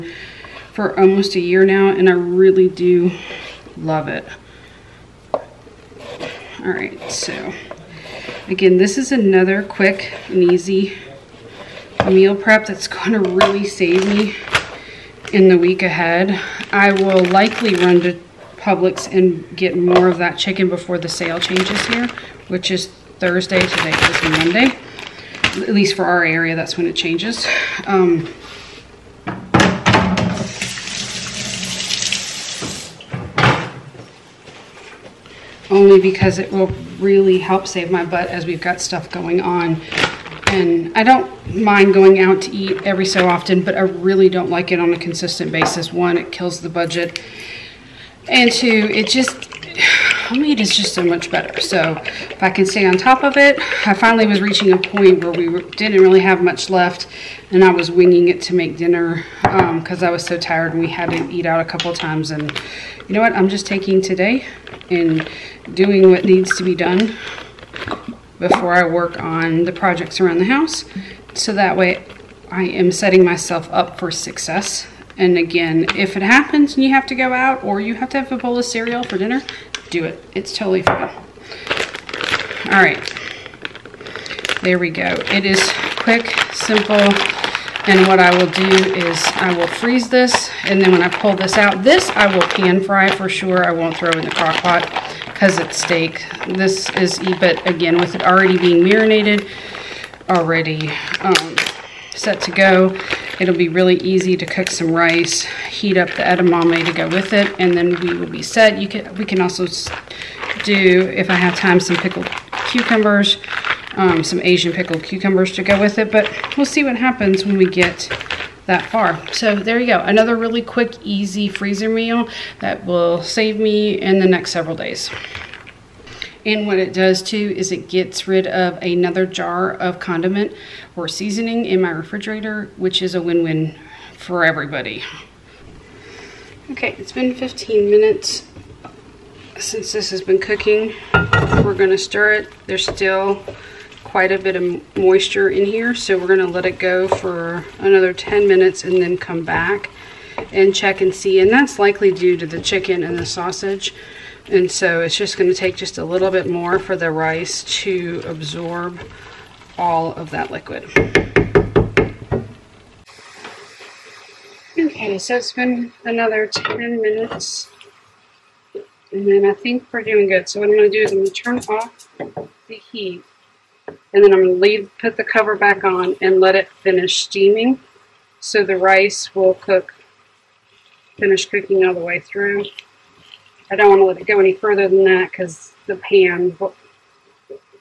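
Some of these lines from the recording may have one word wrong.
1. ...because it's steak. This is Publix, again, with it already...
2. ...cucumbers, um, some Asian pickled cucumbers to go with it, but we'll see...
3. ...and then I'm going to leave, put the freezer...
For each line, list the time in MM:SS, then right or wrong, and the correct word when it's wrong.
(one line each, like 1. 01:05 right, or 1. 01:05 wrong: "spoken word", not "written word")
1. 01:35 wrong: "EBIT", not "Publix"
2. 01:52 right
3. 02:53 wrong: "cover", not "freezer".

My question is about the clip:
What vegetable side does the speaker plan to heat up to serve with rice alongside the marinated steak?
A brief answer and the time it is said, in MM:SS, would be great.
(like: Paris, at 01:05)
edamame, at 01:46.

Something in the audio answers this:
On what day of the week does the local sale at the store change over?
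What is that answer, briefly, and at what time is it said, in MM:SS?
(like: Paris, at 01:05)
Thursday, at 00:23.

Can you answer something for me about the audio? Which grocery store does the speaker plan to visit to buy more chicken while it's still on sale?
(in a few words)
Publix.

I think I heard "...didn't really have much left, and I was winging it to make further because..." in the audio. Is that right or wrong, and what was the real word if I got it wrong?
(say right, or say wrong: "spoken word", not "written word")
wrong: "dinner", not "further".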